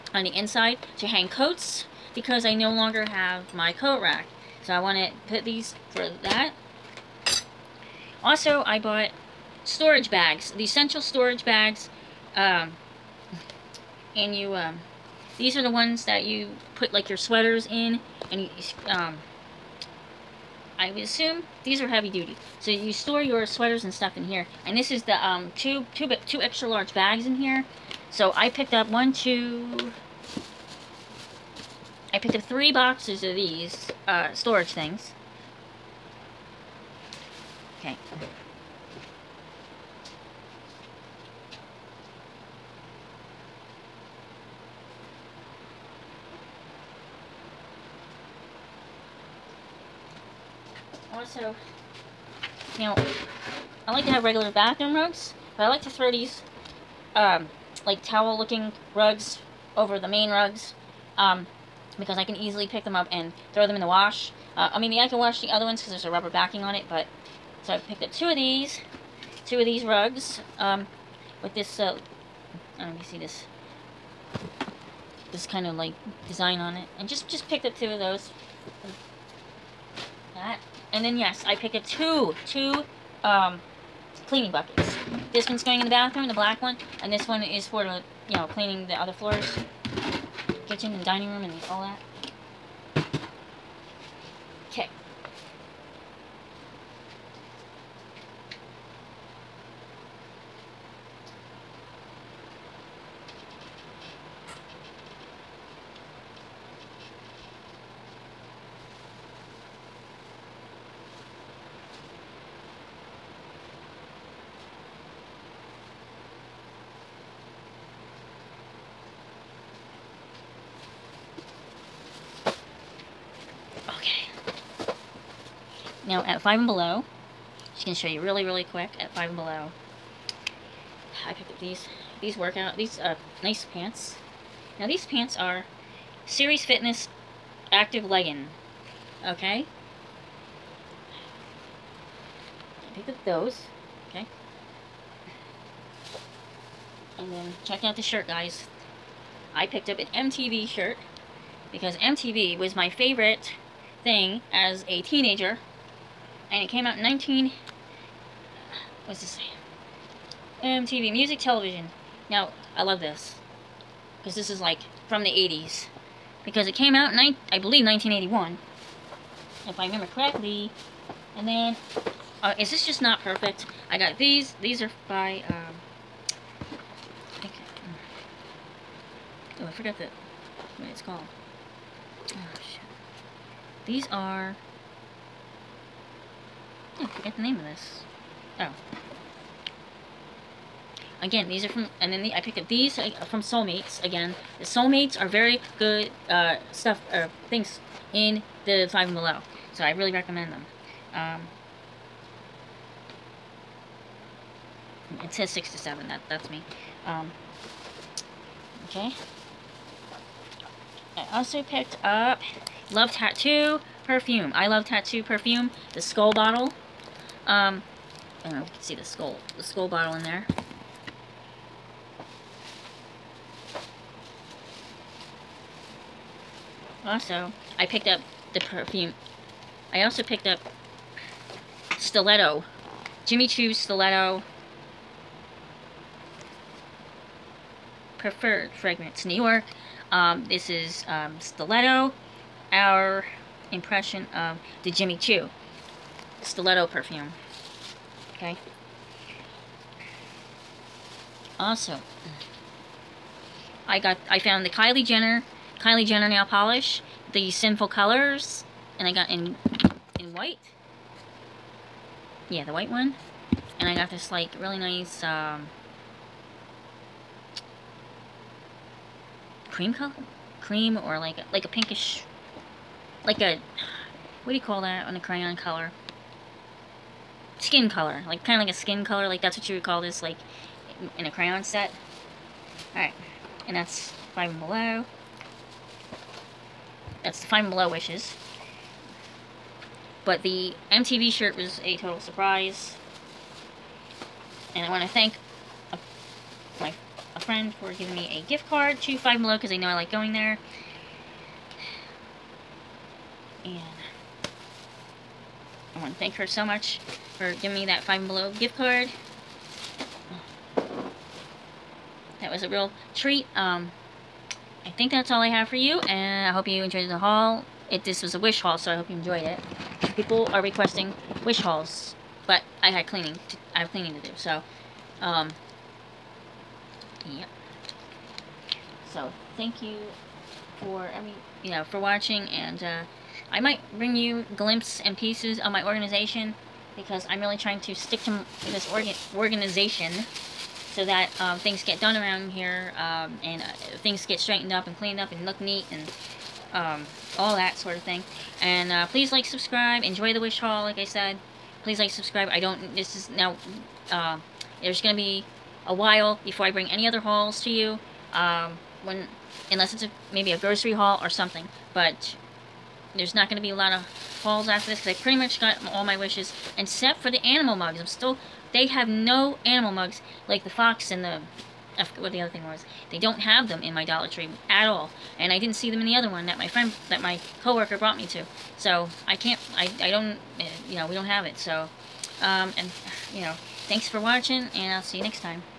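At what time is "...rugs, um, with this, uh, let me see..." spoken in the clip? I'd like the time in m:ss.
1:09.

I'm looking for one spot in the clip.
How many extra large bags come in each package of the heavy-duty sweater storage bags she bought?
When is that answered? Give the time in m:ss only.
0:26.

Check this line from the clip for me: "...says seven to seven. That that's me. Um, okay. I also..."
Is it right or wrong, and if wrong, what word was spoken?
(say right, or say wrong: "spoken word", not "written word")
wrong: "six", not "seven".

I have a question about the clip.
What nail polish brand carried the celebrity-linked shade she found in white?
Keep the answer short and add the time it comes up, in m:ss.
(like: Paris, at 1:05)
Sinful Colors, at 4:17.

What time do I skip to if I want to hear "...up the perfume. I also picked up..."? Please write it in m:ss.
3:48.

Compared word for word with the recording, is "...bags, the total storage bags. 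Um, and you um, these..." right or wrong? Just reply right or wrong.
wrong.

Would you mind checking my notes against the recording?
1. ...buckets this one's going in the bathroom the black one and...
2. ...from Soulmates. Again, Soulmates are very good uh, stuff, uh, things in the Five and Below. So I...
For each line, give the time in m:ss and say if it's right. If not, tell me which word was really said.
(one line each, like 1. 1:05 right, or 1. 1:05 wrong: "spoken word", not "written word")
1. 1:24 right
2. 3:13 right.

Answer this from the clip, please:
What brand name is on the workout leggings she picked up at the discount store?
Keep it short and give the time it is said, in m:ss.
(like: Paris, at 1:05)
Series Fitness, at 2:16.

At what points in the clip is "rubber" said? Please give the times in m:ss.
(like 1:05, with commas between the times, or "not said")
1:06.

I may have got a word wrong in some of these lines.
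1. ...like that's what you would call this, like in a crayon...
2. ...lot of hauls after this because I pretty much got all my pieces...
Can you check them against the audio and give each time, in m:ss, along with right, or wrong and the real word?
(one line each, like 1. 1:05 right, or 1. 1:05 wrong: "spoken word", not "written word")
1. 4:39 right
2. 6:03 wrong: "wishes", not "pieces".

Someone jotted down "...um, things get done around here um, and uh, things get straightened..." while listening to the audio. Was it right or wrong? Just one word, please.
right.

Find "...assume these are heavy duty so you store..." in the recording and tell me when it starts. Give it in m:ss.
0:21.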